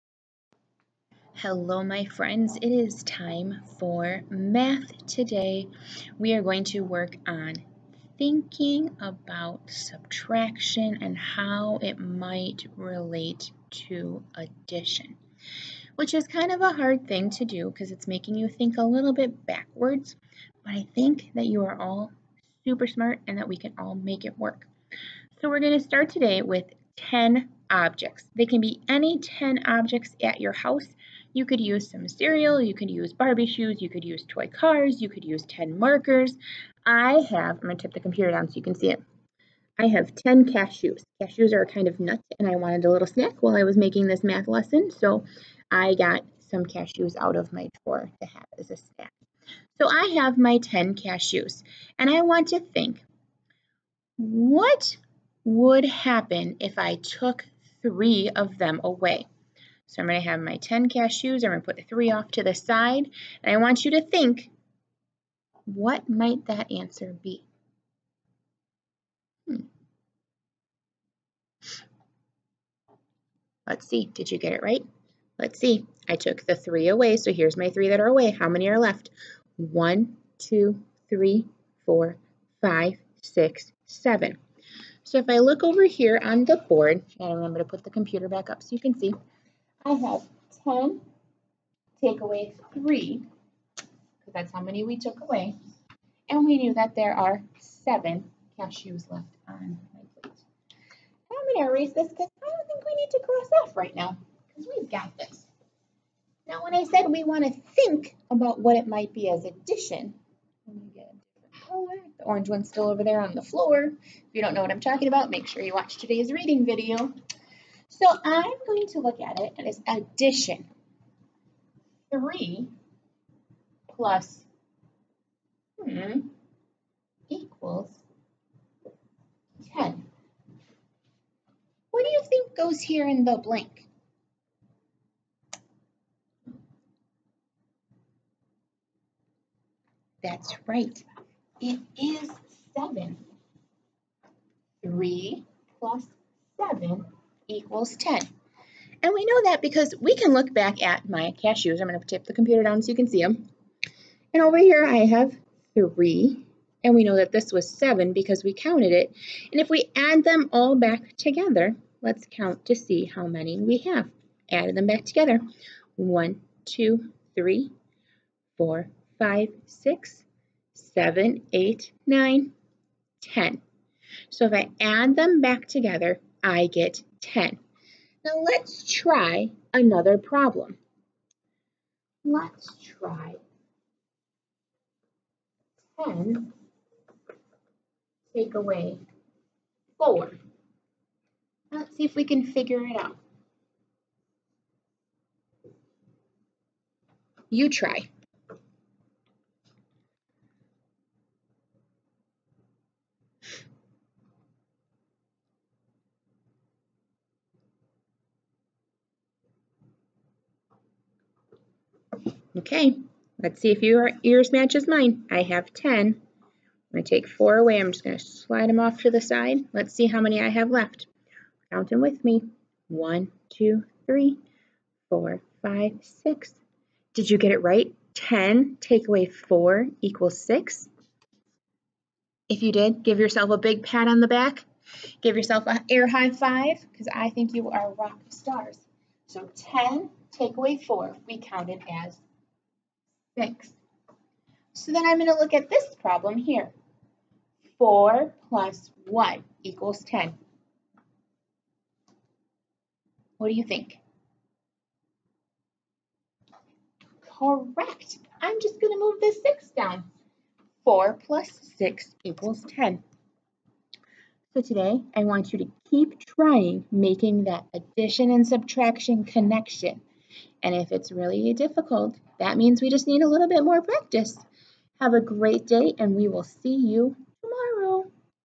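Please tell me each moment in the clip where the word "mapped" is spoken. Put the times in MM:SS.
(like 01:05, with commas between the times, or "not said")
not said.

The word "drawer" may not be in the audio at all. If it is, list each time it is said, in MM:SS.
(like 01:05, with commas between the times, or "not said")
00:47.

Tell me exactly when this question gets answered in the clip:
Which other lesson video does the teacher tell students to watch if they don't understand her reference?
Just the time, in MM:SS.
01:55.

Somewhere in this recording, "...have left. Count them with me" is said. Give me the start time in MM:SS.
03:40.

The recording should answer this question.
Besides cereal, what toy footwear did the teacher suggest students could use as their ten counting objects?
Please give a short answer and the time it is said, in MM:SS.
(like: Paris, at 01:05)
Barbie shoes, at 00:33.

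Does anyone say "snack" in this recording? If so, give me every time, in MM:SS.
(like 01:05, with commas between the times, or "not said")
00:43, 00:48.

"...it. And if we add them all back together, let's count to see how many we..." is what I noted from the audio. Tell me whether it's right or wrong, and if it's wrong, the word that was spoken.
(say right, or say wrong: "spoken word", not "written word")
right.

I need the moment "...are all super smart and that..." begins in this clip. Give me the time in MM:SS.
00:21.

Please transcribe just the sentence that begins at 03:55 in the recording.
Give yourself an air high five because I think you are rock stars.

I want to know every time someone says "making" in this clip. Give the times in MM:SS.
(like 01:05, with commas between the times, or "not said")
00:18, 00:43, 04:26.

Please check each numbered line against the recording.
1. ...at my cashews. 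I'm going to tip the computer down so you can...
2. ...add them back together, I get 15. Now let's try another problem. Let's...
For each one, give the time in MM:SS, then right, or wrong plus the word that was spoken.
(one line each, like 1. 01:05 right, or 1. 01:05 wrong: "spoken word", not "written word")
1. 02:30 right
2. 02:54 wrong: "10", not "15".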